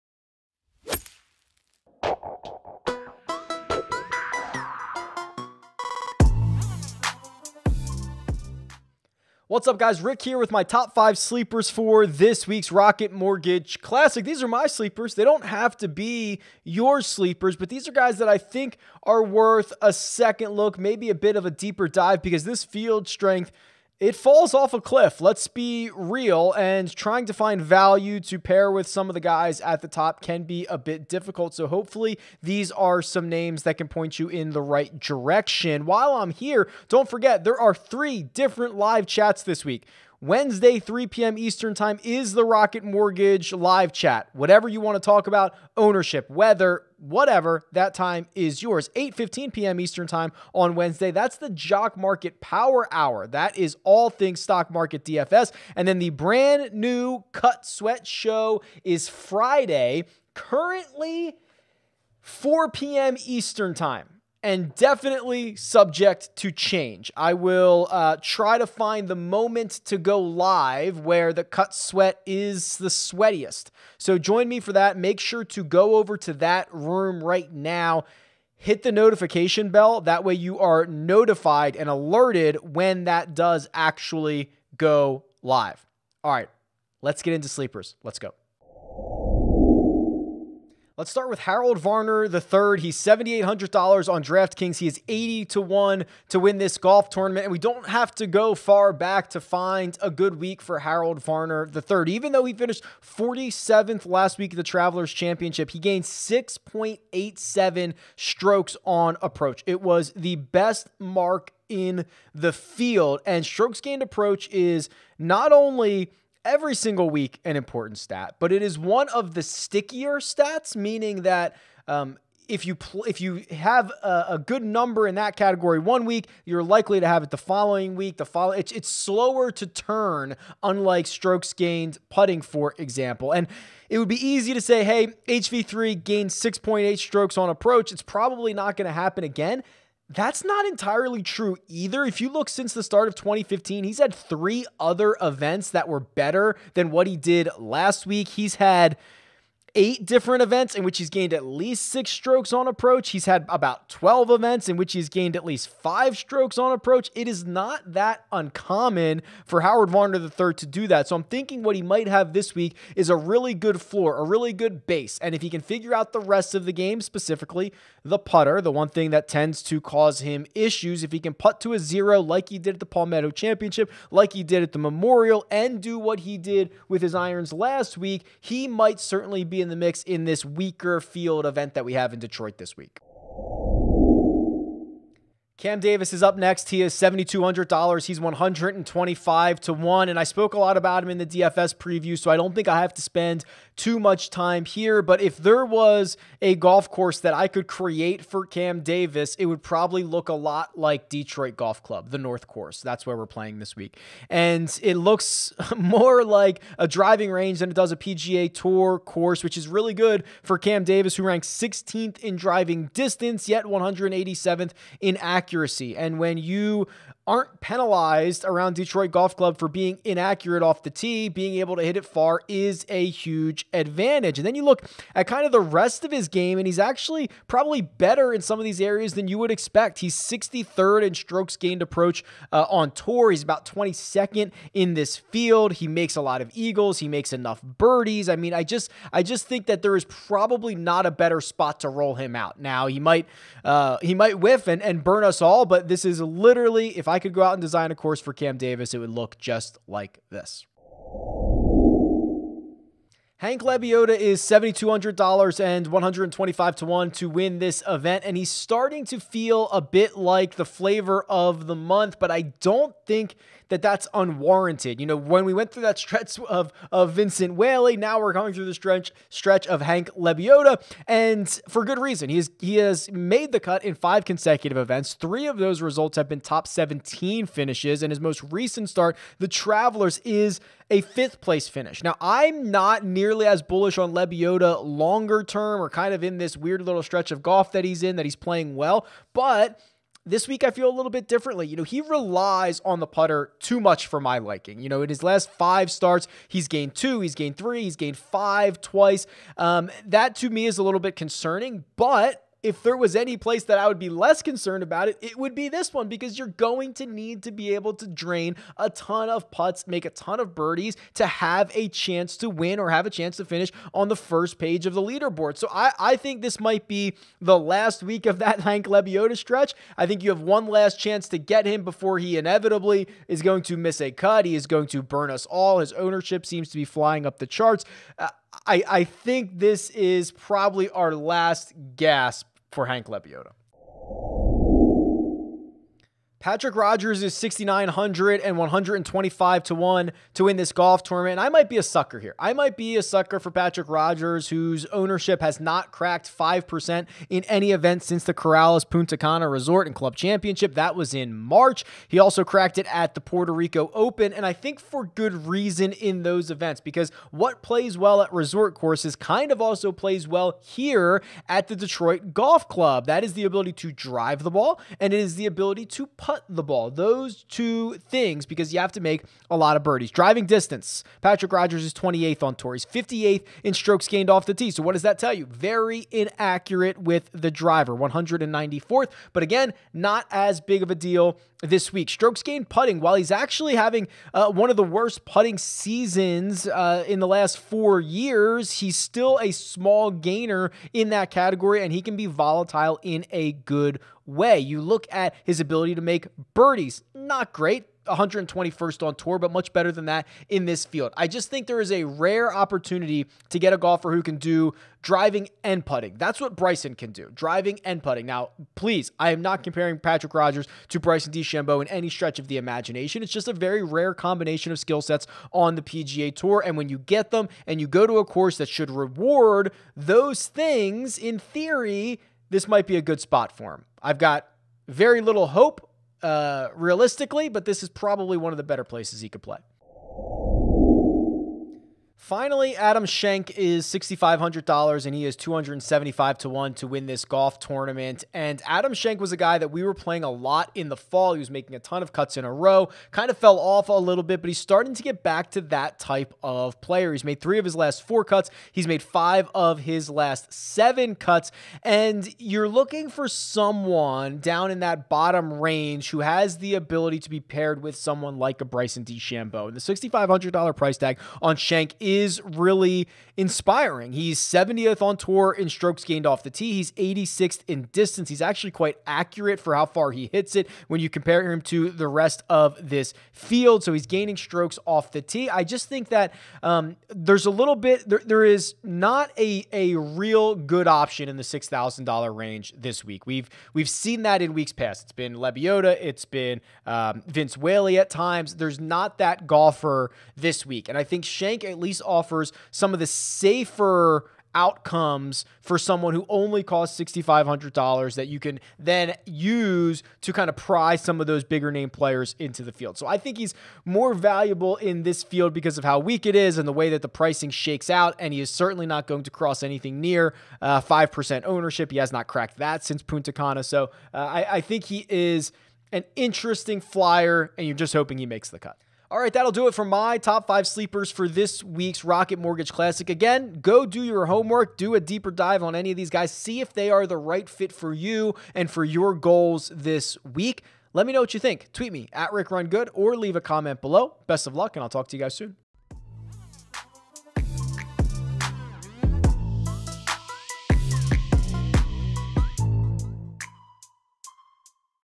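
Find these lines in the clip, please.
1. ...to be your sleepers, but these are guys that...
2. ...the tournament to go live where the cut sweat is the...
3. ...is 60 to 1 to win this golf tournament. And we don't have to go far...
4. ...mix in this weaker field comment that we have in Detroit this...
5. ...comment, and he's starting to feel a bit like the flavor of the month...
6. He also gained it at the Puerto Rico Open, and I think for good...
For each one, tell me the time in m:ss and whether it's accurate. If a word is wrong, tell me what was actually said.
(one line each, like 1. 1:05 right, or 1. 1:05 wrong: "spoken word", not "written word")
1. 0:15 right
2. 1:09 wrong: "moment", not "tournament"
3. 1:34 wrong: "80", not "60"
4. 2:59 wrong: "event", not "comment"
5. 4:17 wrong: "event", not "comment"
6. 5:52 wrong: "cracked", not "gained".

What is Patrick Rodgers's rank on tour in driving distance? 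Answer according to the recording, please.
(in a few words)
28th.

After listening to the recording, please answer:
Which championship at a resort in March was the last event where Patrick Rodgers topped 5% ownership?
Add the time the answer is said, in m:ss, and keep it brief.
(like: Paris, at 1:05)
Corales Punta Cana Resort and Club Championship, at 5:48.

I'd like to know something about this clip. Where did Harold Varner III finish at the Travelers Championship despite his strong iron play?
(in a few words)
47th.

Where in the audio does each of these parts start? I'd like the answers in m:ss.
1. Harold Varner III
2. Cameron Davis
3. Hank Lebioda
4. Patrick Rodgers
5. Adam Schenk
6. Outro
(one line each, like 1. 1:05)
1. 1:28
2. 3:03
3. 4:11
4. 5:34
5. 7:10
6. 8:37.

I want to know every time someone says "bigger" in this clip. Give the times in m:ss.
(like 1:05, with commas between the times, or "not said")
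8:21.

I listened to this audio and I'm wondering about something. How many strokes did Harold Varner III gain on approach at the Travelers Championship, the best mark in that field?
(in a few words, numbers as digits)
6.87.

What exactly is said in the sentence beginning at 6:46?
That's what Bryson can do, driving and putting.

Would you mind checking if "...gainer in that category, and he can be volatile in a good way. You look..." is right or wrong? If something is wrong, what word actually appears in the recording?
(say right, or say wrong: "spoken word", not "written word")
right.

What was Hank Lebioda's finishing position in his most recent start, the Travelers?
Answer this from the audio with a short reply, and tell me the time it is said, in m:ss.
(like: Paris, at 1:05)
Fifth, at 4:40.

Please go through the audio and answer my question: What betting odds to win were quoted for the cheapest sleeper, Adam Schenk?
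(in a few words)
275 to 1.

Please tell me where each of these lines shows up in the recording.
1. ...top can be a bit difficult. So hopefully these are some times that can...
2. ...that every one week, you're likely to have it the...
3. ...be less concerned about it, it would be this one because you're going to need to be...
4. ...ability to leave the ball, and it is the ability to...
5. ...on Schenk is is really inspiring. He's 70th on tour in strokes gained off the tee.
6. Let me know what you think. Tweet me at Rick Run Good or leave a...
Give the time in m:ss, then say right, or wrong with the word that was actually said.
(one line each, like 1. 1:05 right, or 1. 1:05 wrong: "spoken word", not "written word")
1. 0:29 wrong: "names", not "times"
2. 2:05 wrong: "category", not "every"
3. 5:03 right
4. 6:03 wrong: "drive", not "leave"
5. 7:41 right
6. 8:50 right.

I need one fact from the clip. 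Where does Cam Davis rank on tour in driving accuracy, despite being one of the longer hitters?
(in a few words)
187th.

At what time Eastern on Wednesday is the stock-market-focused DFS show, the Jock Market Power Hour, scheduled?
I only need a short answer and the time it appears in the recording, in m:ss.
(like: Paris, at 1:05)
8:15 p.m., at 0:48.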